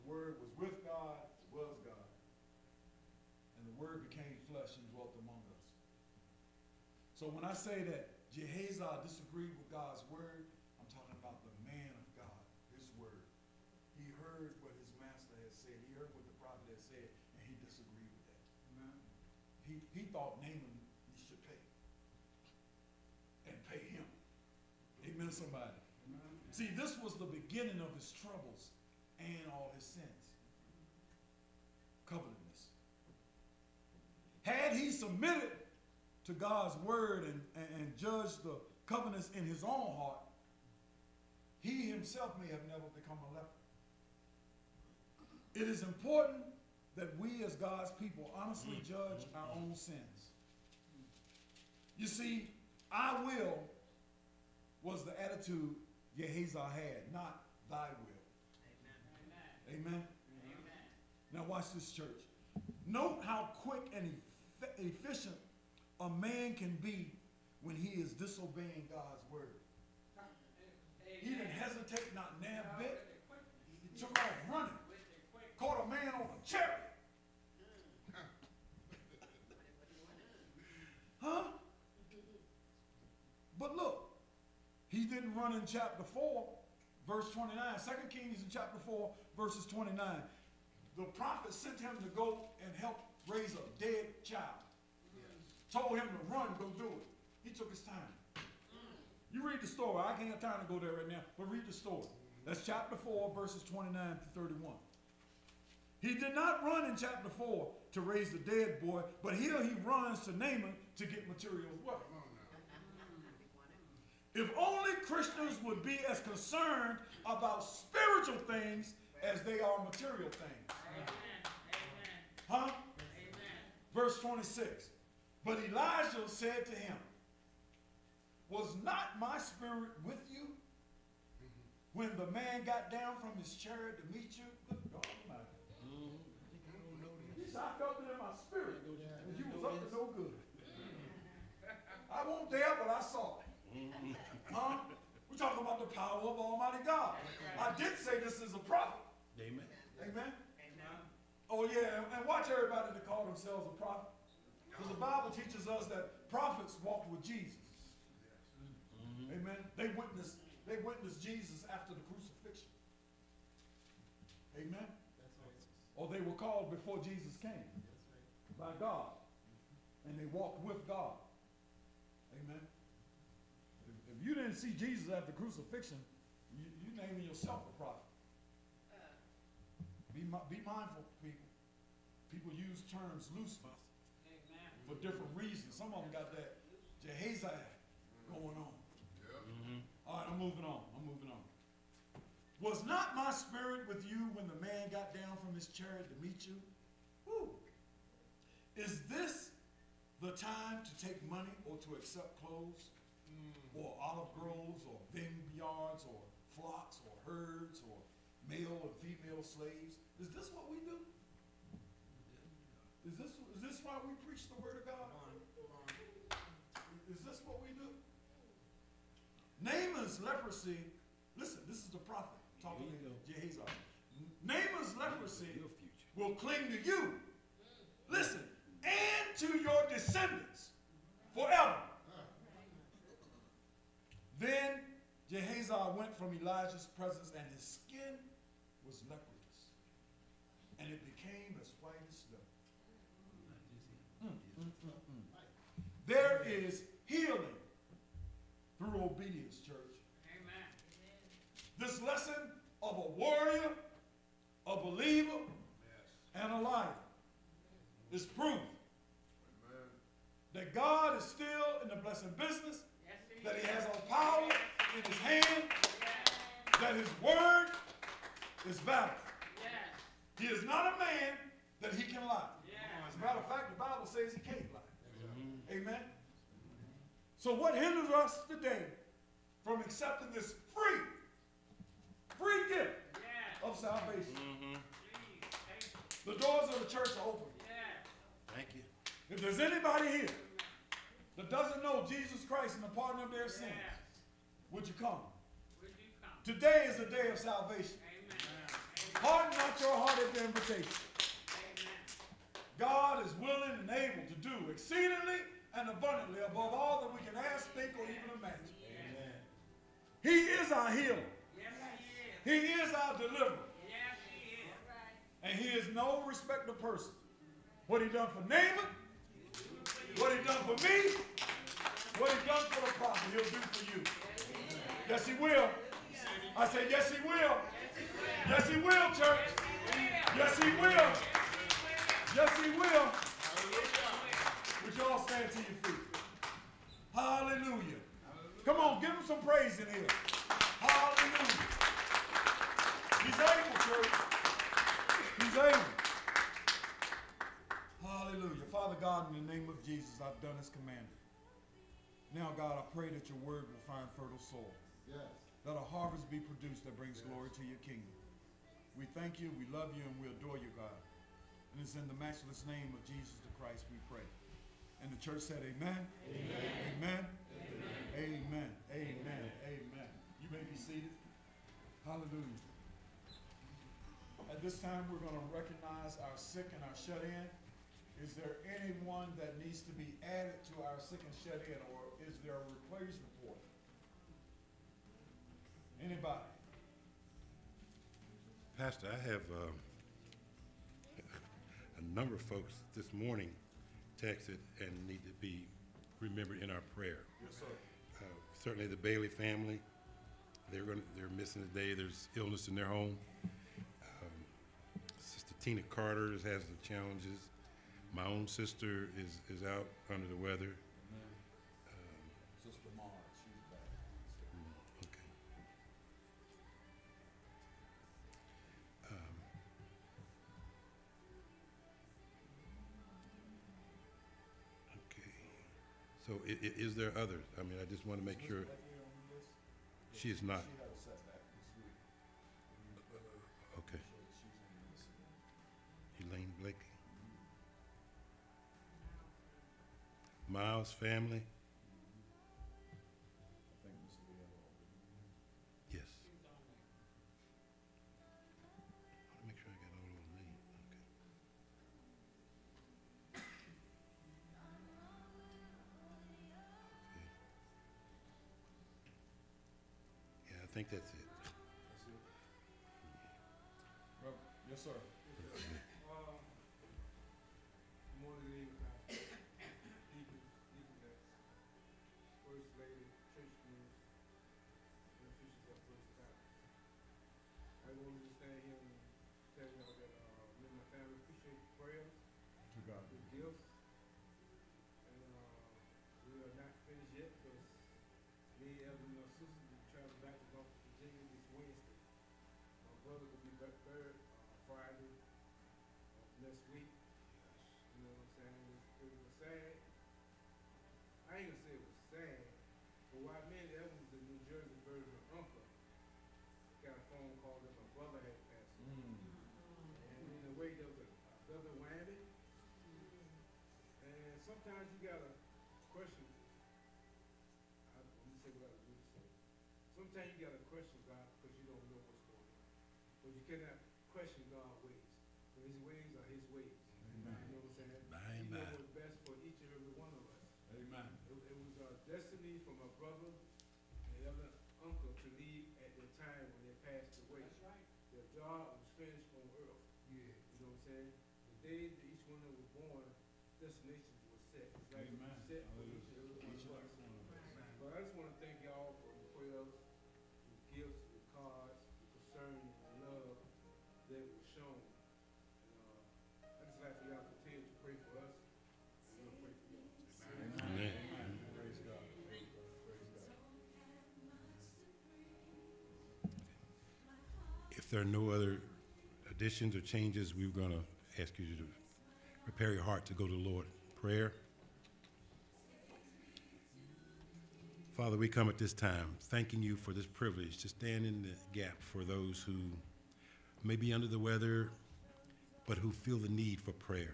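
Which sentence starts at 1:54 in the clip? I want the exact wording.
If only Christians would be as concerned about spiritual things as they are material things.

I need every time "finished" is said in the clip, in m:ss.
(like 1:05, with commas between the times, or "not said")
8:06, 8:58.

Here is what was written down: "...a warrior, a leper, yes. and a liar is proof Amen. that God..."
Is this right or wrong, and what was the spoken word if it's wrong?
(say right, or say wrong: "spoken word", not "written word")
wrong: "believer", not "leper".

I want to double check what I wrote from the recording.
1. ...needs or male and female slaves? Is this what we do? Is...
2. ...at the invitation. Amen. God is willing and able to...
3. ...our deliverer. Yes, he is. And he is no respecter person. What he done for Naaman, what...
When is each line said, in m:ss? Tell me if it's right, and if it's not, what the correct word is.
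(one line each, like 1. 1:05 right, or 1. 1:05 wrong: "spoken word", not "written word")
1. 3:27 wrong: "herds", not "needs"
2. 5:00 right
3. 5:12 right.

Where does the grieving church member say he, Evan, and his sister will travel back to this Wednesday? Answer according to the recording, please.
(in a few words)
North Virginia.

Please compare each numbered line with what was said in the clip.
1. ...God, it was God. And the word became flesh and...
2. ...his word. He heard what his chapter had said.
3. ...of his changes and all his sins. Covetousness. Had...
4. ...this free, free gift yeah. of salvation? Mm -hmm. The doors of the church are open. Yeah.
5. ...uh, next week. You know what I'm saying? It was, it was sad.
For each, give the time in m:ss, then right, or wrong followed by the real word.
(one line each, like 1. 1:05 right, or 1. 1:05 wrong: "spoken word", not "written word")
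1. 0:00 right
2. 0:12 wrong: "master", not "chapter"
3. 0:27 wrong: "troubles", not "changes"
4. 4:40 right
5. 8:16 right.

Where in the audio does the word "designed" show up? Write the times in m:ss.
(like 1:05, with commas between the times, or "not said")
not said.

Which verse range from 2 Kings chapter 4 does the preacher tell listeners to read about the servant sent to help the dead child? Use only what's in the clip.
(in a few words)
29 to 31.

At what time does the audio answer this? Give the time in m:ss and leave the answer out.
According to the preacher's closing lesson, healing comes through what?
4:09.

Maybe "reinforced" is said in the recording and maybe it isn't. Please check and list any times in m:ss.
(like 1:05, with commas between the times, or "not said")
not said.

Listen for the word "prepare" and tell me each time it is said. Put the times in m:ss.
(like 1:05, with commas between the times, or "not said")
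9:32.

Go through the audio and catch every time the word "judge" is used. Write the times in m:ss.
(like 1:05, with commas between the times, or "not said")
0:37, 0:48.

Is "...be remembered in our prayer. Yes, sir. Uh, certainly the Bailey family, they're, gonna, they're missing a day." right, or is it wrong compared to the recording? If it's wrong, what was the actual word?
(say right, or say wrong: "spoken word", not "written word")
right.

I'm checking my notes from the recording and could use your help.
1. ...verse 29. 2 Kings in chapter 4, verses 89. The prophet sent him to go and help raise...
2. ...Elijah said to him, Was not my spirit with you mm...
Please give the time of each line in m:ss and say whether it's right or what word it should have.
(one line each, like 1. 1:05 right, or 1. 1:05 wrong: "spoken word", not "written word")
1. 1:27 wrong: "29", not "89"
2. 2:05 right.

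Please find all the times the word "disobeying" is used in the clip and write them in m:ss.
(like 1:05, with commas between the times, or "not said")
1:08.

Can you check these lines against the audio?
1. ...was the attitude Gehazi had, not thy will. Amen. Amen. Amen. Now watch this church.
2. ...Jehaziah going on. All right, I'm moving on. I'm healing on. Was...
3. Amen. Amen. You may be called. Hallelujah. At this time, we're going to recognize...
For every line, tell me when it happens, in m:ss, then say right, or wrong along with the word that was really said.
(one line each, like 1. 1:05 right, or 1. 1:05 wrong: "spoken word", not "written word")
1. 0:54 right
2. 3:06 wrong: "moving", not "healing"
3. 6:08 wrong: "seated", not "called".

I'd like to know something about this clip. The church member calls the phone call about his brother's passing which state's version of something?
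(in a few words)
New Jersey.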